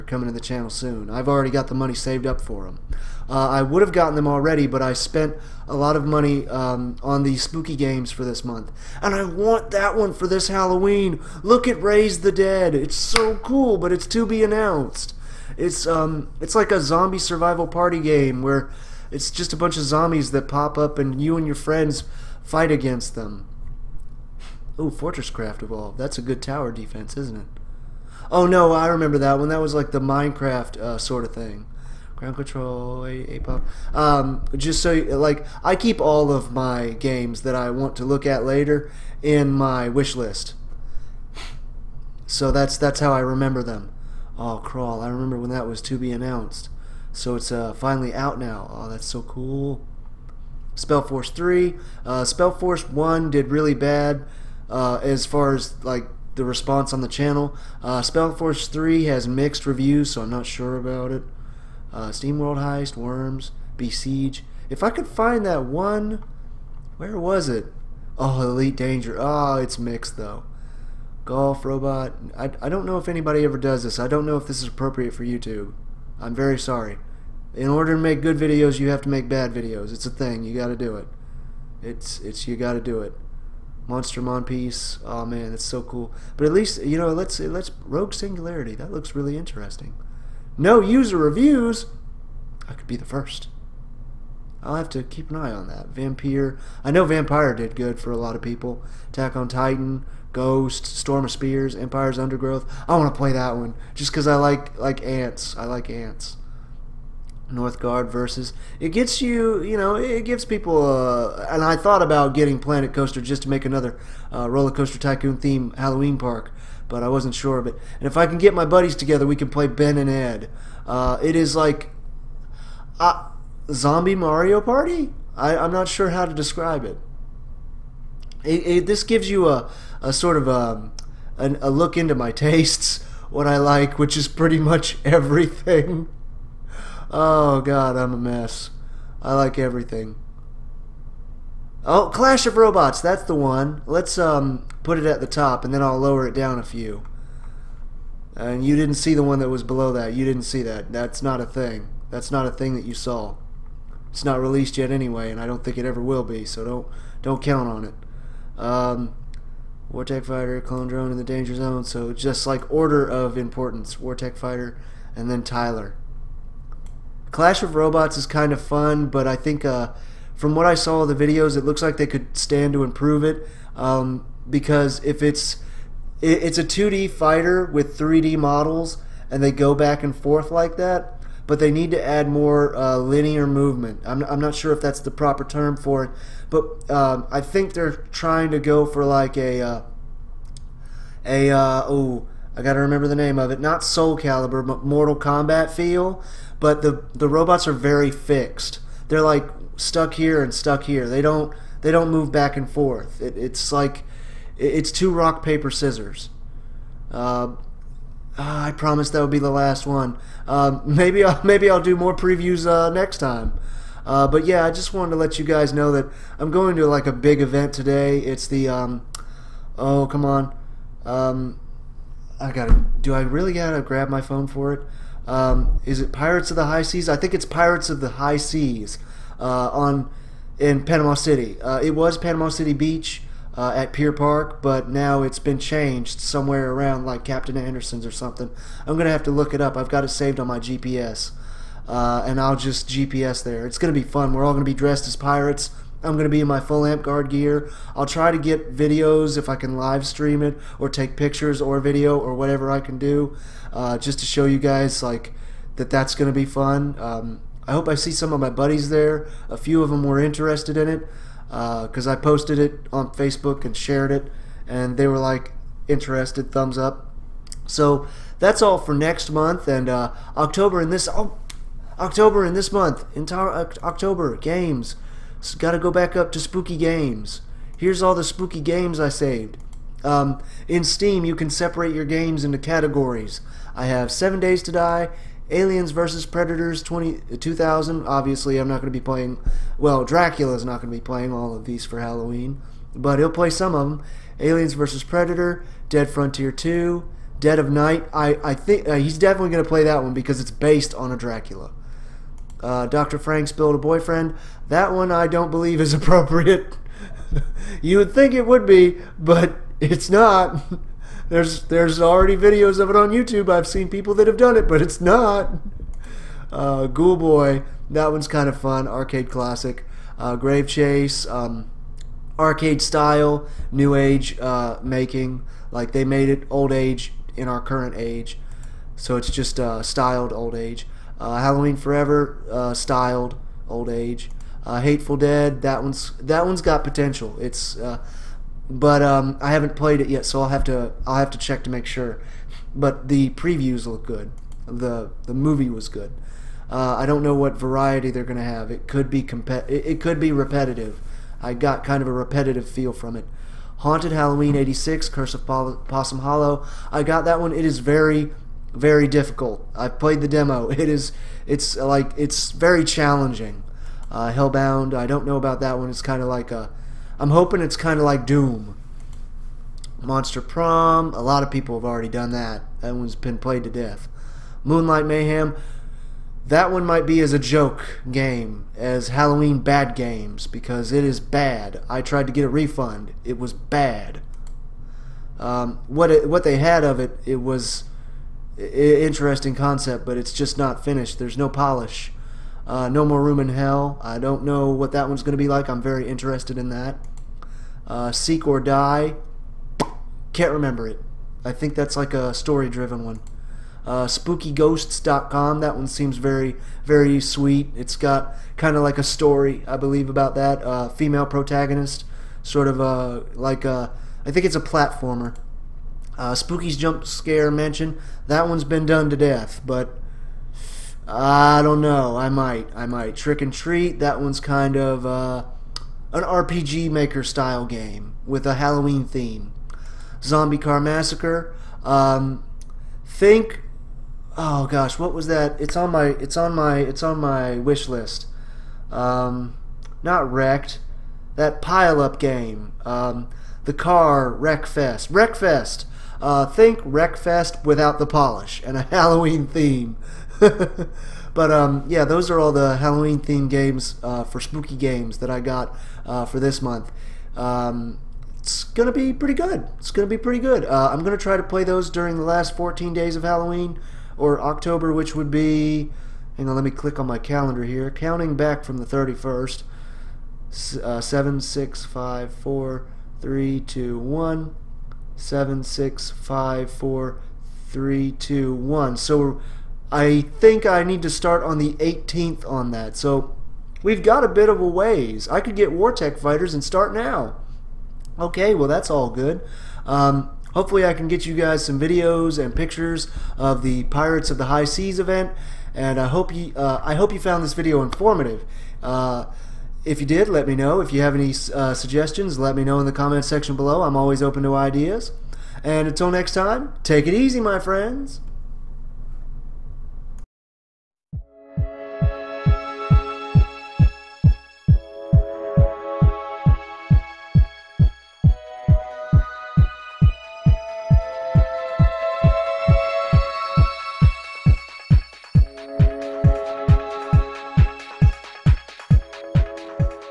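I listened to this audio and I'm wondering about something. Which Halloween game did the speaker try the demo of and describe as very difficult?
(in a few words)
Haunted Halloween 86.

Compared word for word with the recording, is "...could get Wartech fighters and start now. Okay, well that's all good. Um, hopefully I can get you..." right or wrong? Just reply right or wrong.
right.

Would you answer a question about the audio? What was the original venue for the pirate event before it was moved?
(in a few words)
Pier Park.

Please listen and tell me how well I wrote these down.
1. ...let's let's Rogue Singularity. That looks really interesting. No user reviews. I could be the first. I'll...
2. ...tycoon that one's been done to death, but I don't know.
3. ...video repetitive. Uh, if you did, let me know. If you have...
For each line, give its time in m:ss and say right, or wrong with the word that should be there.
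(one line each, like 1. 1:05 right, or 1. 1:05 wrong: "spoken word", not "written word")
1. 1:27 right
2. 6:57 wrong: "mansion", not "tycoon"
3. 8:17 wrong: "informative", not "repetitive".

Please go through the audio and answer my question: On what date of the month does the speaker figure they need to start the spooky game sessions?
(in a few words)
18th.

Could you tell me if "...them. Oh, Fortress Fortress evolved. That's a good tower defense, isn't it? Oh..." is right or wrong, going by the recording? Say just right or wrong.
wrong.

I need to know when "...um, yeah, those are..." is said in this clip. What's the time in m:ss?
7:31.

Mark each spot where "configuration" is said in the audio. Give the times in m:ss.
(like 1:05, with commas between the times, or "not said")
not said.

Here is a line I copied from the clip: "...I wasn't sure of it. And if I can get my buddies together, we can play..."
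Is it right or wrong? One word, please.
right.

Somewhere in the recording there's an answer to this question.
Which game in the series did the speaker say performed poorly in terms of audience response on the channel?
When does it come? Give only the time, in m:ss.
0:52.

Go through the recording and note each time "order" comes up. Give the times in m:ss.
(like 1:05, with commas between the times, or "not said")
1:17, 2:42.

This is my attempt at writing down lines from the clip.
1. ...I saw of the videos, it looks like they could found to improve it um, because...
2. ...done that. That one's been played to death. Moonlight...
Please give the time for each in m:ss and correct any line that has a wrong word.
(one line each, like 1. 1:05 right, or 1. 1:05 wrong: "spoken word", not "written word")
1. 2:50 wrong: "stand", not "found"
2. 6:12 right.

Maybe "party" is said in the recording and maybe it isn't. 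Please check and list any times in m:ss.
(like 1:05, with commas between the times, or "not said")
0:17, 2:04.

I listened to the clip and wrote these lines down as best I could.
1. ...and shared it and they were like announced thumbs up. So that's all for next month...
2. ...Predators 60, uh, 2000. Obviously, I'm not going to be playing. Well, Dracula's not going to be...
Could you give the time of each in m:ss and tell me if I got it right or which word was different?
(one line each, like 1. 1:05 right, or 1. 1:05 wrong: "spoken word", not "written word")
1. 4:23 wrong: "interested", not "announced"
2. 4:46 wrong: "20", not "60".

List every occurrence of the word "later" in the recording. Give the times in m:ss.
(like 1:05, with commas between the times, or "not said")
0:38.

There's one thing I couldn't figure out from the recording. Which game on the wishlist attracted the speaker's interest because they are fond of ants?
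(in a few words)
Empire's Undergrowth.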